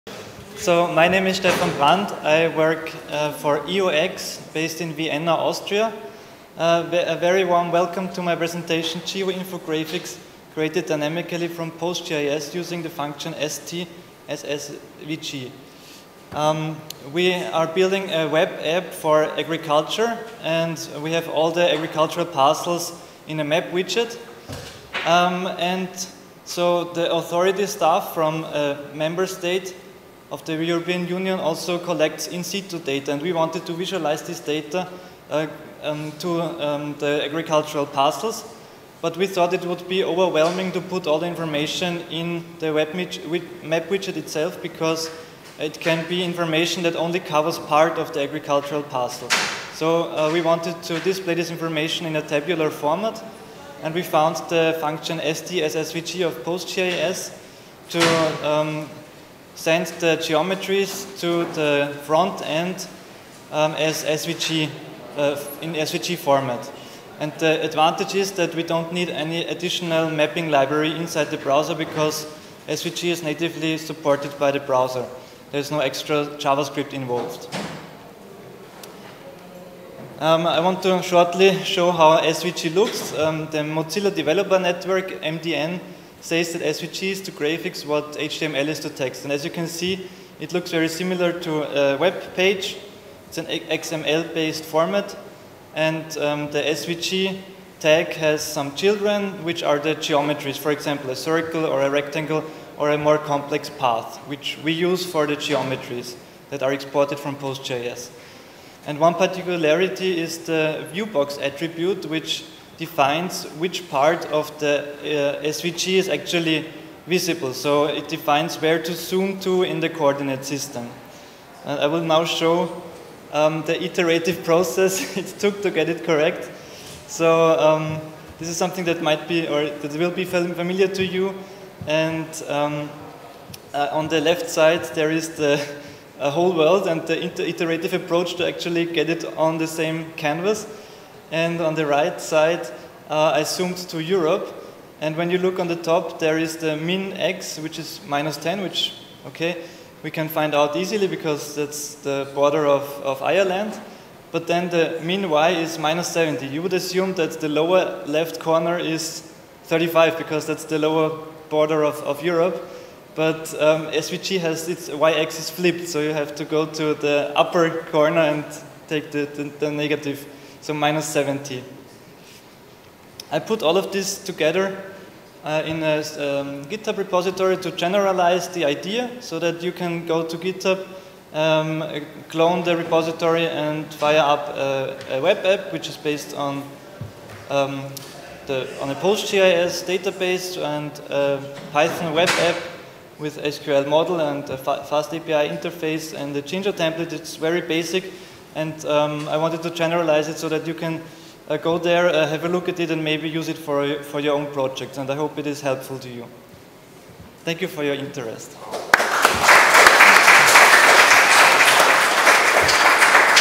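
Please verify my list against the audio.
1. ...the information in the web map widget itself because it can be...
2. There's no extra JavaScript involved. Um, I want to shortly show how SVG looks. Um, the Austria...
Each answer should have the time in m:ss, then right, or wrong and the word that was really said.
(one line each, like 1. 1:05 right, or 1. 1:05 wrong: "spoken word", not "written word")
1. 0:41 right
2. 1:15 wrong: "Mozilla", not "Austria".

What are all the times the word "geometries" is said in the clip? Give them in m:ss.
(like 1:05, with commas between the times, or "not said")
1:00, 1:39, 1:45.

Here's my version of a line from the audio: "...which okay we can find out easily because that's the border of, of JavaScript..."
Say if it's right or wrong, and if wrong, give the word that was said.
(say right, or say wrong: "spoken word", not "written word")
wrong: "Ireland", not "JavaScript".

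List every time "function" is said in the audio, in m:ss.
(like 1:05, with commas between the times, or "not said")
0:12, 0:54.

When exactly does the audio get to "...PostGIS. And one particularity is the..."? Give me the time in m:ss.
1:47.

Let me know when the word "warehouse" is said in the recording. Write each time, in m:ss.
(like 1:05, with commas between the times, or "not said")
not said.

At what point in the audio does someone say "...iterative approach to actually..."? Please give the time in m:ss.
2:17.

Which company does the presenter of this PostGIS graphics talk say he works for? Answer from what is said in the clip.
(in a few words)
EOX.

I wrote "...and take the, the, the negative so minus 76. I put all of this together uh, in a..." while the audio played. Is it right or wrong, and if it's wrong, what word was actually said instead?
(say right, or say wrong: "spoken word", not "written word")
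wrong: "70", not "76".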